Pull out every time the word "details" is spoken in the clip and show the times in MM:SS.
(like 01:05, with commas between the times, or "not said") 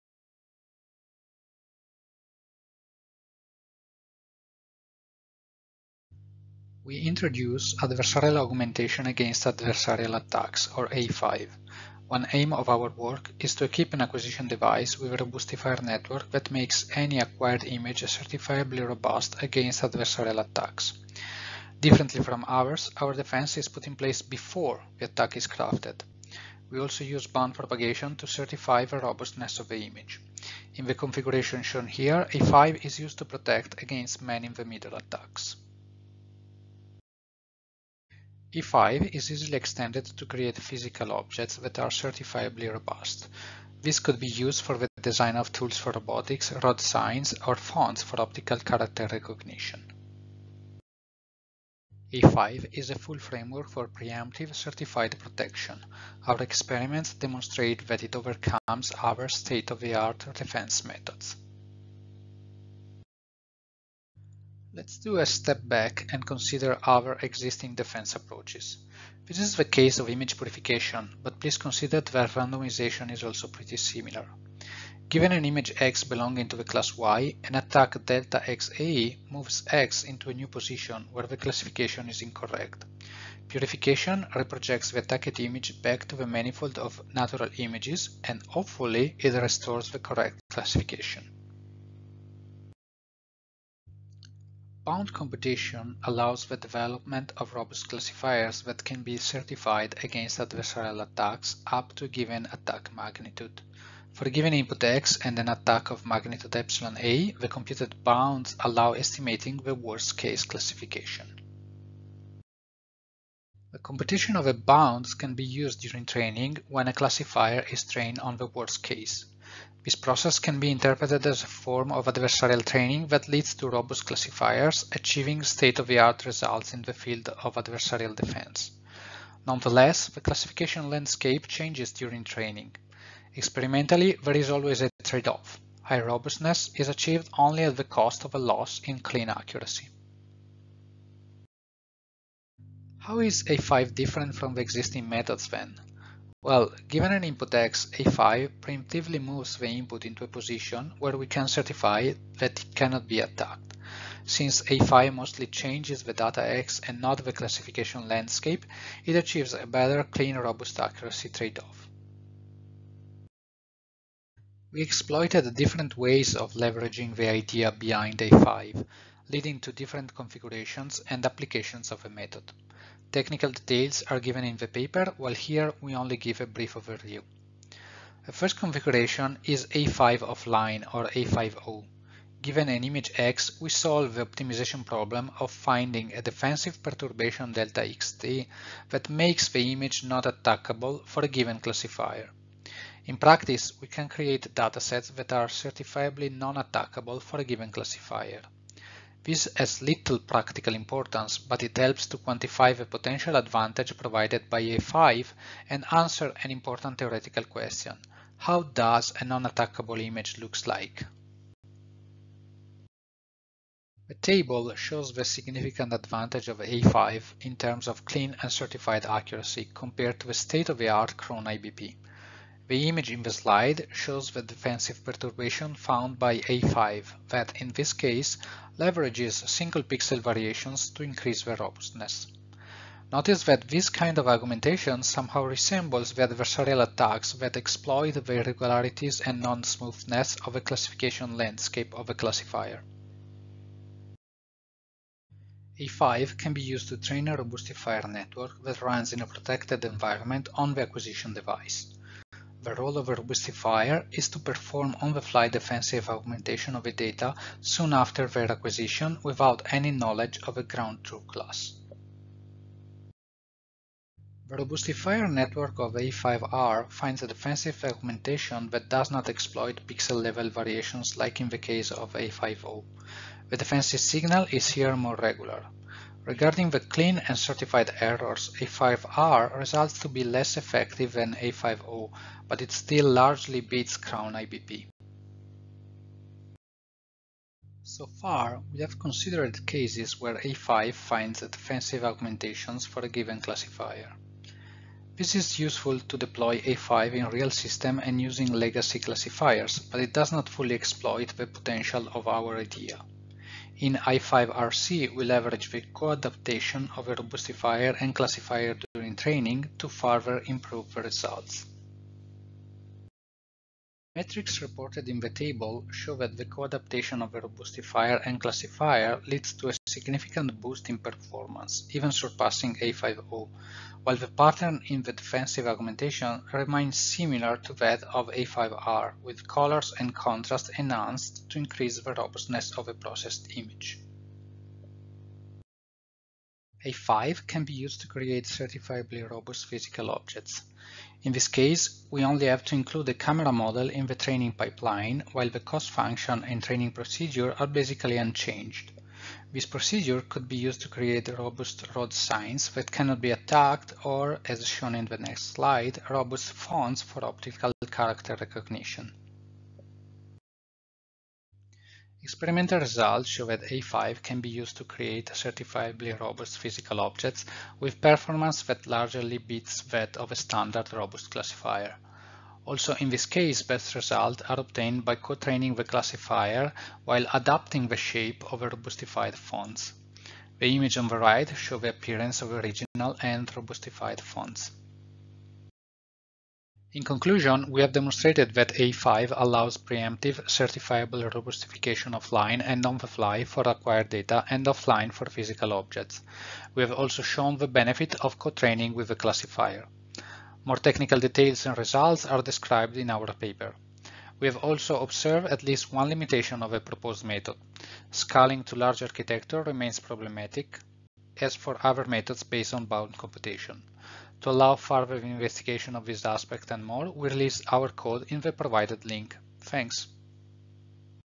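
02:53, 06:41.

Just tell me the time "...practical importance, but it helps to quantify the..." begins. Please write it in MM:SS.
03:20.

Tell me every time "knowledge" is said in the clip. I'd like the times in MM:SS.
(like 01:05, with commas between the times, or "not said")
04:19.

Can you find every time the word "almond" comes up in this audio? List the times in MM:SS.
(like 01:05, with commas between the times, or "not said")
not said.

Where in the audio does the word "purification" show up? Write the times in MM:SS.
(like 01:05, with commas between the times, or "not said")
01:10, 01:23.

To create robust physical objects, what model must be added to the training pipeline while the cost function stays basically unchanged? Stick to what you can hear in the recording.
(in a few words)
Camera model.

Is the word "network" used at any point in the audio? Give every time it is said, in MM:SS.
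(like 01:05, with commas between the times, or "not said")
00:15, 04:08, 04:25.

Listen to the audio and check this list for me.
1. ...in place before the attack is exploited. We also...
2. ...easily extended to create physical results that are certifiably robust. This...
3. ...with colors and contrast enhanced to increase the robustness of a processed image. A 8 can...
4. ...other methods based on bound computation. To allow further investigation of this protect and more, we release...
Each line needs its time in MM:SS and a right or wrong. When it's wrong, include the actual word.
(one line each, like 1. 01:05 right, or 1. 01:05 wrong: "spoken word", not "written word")
1. 00:23 wrong: "crafted", not "exploited"
2. 00:39 wrong: "objects", not "results"
3. 05:29 wrong: "5", not "8"
4. 06:51 wrong: "aspect", not "protect".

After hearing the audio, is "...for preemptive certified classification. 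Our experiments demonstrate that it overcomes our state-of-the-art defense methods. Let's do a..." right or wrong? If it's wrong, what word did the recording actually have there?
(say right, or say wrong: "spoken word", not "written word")
wrong: "protection", not "classification".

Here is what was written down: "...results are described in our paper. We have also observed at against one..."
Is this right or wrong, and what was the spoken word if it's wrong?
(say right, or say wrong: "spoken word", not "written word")
wrong: "least", not "against".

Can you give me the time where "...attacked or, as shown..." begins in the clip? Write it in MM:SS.
05:53.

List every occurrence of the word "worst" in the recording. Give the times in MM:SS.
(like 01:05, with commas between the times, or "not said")
01:49, 01:58.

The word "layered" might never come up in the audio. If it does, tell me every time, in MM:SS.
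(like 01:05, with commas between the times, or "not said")
not said.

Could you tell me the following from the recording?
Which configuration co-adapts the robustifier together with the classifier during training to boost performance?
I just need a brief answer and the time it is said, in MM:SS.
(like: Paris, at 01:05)
A5RC, at 05:03.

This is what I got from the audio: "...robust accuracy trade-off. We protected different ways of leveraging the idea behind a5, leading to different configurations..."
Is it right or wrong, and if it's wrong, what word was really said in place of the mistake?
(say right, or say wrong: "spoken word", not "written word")
wrong: "exploited", not "protected".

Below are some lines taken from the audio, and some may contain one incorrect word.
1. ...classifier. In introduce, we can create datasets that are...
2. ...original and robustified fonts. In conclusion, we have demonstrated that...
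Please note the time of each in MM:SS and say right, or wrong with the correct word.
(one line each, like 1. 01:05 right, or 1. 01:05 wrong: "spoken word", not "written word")
1. 03:11 wrong: "practice", not "introduce"
2. 06:22 right.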